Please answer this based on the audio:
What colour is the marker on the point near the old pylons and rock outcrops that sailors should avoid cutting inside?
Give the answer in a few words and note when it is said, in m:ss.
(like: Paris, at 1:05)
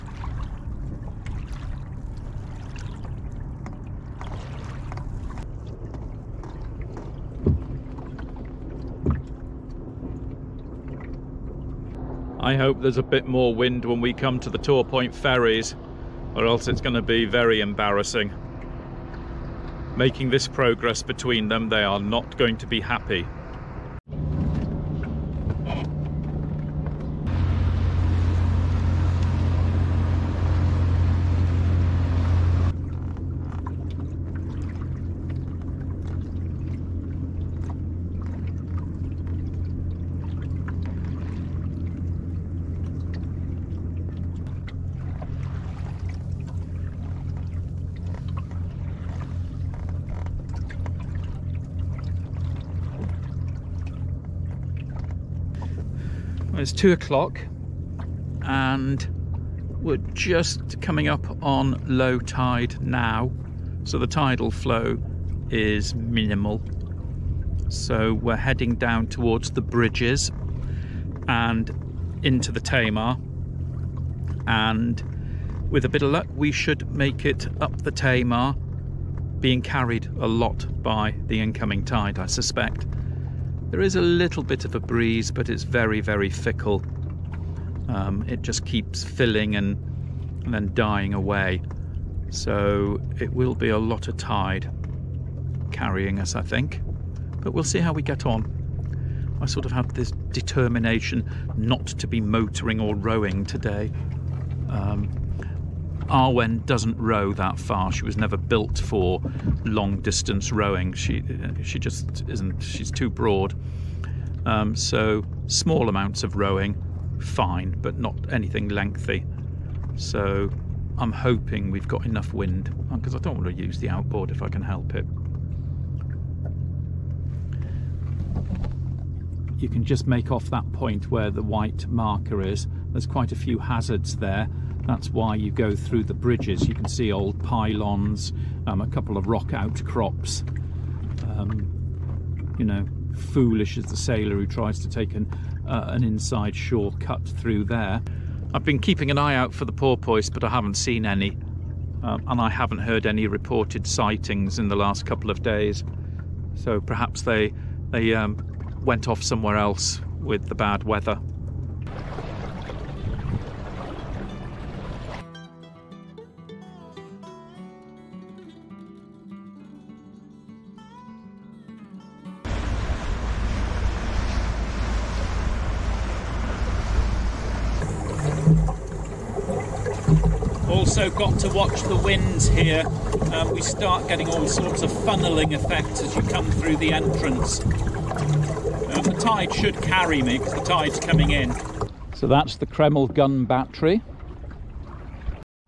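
White, at 2:11.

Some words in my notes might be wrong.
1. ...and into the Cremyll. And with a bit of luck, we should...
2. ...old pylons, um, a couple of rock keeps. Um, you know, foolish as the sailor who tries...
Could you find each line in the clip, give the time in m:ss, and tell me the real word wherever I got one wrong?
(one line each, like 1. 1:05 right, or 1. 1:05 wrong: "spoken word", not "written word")
1. 1:11 wrong: "Tamar", not "Cremyll"
2. 2:17 wrong: "outcrops", not "keeps".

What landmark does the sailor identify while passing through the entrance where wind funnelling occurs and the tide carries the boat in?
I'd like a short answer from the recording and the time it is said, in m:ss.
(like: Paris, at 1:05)
Cremyll gun battery, at 3:12.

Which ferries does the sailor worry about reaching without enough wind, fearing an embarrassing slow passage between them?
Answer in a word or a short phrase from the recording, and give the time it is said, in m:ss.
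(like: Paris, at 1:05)
Torpoint ferries, at 0:14.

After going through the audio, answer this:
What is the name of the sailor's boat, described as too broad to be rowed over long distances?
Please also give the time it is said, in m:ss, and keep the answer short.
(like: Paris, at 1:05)
Arwen, at 1:46.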